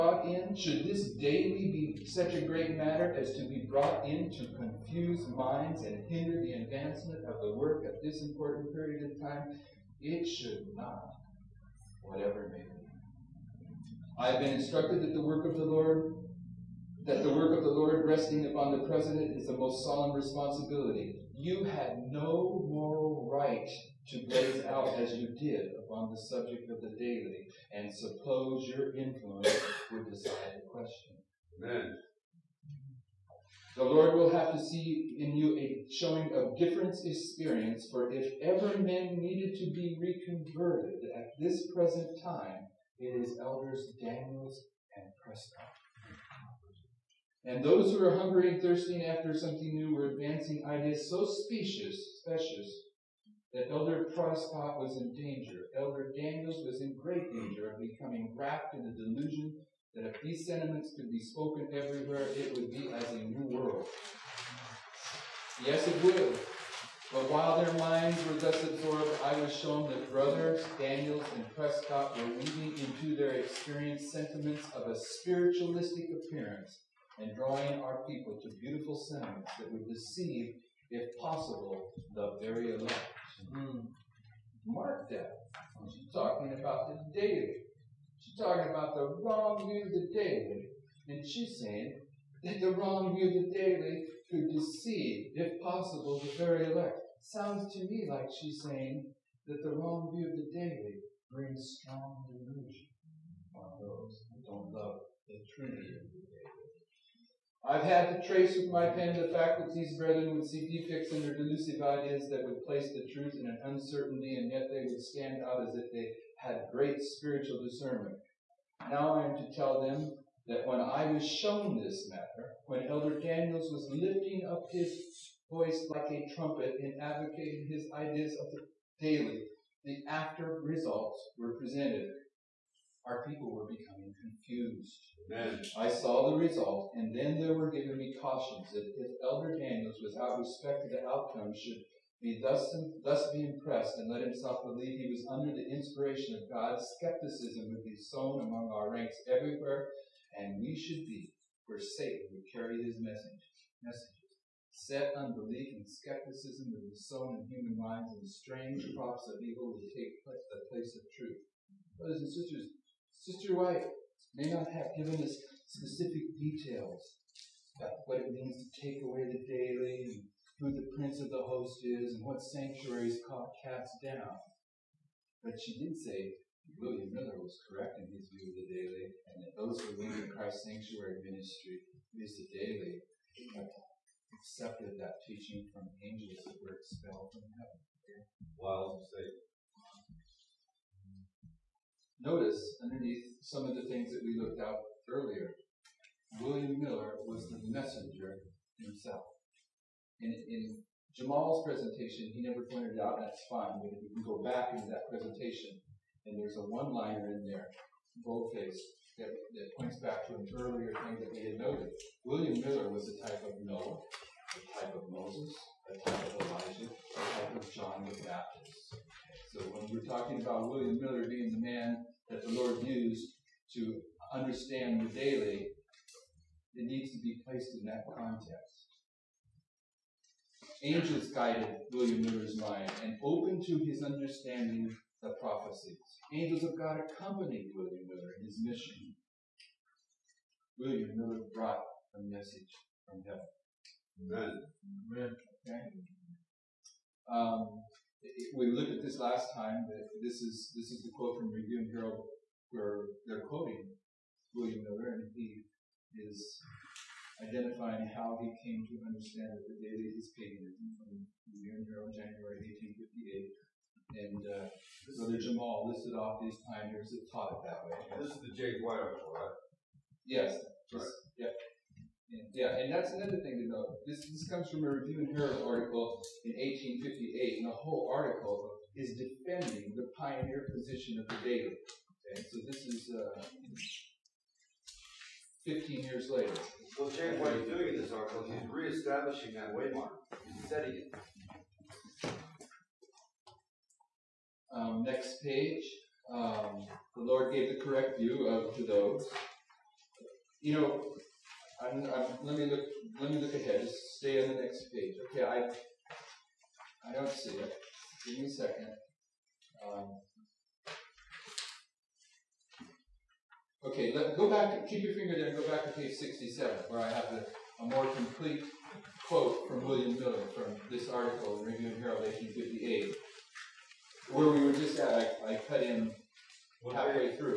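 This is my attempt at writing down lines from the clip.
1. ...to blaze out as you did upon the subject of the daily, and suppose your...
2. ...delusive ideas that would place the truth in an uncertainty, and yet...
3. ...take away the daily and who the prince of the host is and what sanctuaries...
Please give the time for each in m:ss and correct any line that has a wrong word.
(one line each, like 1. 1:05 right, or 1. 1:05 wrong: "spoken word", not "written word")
1. 0:24 right
2. 1:51 right
3. 2:48 right.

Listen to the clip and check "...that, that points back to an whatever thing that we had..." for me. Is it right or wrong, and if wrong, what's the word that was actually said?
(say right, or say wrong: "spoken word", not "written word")
wrong: "earlier", not "whatever".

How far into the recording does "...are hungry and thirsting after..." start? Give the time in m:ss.
0:48.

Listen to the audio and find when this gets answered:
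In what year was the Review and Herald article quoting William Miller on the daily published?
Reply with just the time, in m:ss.
4:22.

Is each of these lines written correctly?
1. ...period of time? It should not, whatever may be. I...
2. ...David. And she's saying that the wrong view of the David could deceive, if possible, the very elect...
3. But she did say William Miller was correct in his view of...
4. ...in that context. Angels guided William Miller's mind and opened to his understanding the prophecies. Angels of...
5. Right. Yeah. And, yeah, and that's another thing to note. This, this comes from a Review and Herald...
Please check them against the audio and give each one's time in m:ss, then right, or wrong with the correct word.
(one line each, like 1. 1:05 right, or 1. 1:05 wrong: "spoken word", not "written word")
1. 0:08 right
2. 1:30 right
3. 2:55 right
4. 3:47 right
5. 4:30 right.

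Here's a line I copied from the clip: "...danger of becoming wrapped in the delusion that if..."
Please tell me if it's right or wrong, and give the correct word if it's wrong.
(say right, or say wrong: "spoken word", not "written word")
right.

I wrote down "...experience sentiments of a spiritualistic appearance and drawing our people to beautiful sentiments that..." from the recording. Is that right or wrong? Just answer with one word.
right.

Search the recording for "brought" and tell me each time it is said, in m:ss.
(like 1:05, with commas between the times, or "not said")
0:03, 4:01.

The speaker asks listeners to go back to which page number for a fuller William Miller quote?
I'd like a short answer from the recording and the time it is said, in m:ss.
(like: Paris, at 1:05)
67, at 5:15.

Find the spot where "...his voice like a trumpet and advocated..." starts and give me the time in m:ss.
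2:04.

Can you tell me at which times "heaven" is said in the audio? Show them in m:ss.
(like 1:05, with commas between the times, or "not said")
3:07, 4:03.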